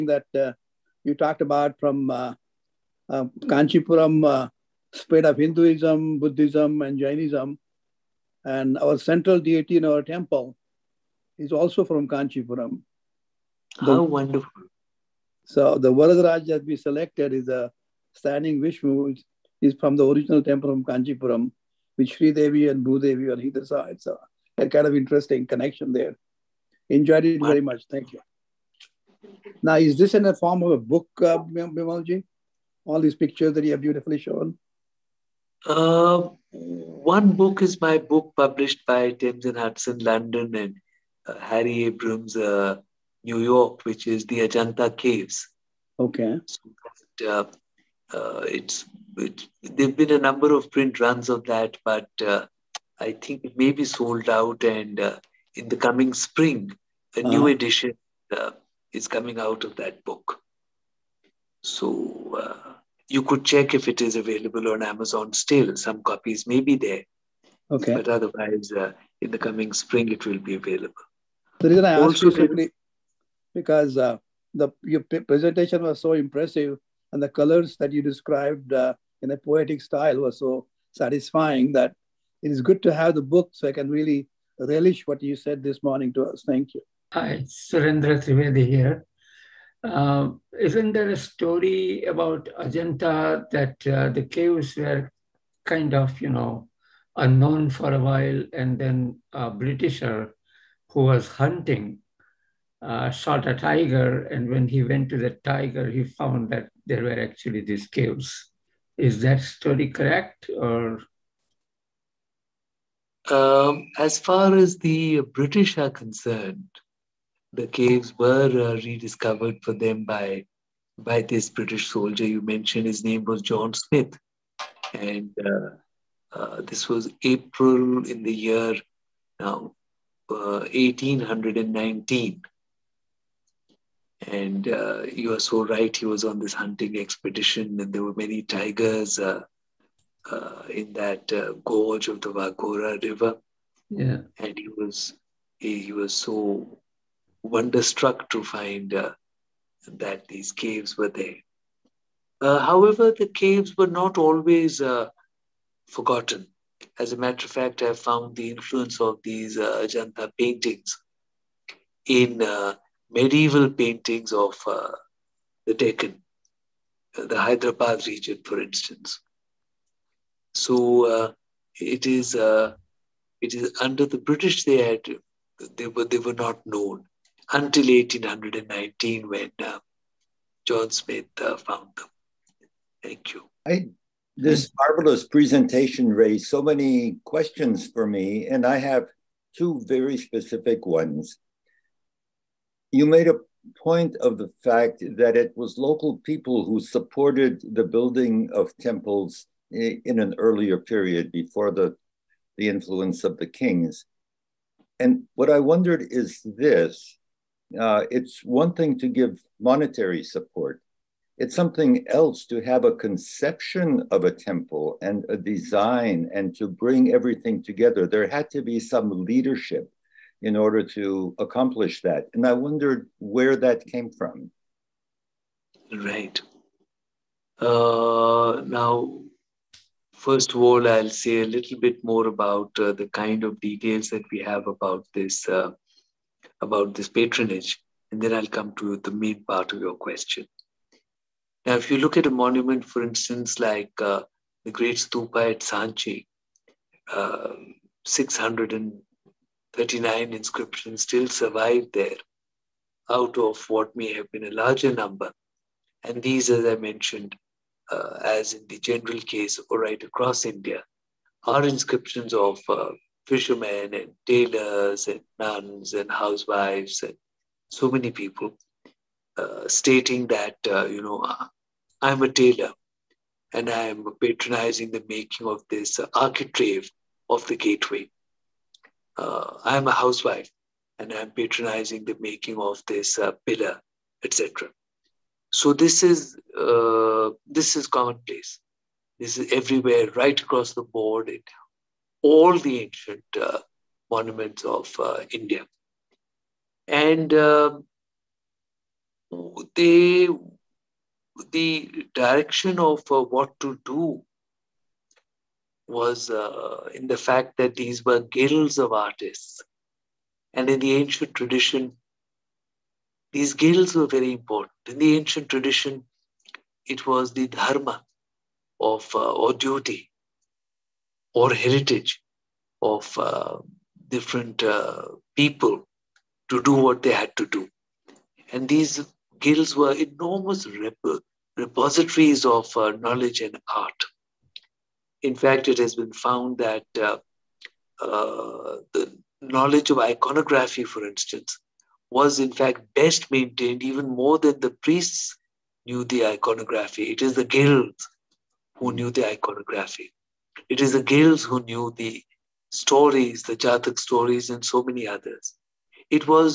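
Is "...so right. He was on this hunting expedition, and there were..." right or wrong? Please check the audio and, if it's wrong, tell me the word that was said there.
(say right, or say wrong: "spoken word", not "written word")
right.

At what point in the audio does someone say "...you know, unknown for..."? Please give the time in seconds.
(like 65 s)
96 s.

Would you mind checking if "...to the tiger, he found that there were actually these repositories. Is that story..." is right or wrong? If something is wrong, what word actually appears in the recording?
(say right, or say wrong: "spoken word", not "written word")
wrong: "caves", not "repositories".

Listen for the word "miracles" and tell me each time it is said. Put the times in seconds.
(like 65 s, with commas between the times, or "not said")
not said.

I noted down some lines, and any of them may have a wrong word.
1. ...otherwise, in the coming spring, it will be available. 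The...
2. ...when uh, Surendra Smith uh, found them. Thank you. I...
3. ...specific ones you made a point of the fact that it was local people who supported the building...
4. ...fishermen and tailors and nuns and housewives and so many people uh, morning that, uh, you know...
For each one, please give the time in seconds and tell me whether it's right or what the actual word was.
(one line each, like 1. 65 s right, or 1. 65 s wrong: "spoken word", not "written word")
1. 68 s right
2. 179 s wrong: "John", not "Surendra"
3. 190 s right
4. 263 s wrong: "stating", not "morning".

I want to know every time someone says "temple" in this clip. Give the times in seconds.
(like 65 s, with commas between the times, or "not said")
9 s, 20 s, 198 s, 214 s.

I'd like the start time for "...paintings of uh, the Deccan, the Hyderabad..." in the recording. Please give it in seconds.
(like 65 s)
163 s.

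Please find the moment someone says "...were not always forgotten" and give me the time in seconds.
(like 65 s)
153 s.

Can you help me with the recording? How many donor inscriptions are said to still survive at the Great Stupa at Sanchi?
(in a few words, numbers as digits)
639.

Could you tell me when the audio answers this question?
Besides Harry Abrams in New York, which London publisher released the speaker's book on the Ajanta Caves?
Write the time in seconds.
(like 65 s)
39 s.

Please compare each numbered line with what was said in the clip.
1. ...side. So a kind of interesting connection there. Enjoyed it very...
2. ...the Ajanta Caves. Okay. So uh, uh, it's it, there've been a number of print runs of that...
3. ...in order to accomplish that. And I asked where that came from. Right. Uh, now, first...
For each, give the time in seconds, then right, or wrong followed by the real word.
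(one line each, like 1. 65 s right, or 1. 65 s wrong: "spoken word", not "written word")
1. 23 s right
2. 44 s right
3. 220 s wrong: "wondered", not "asked".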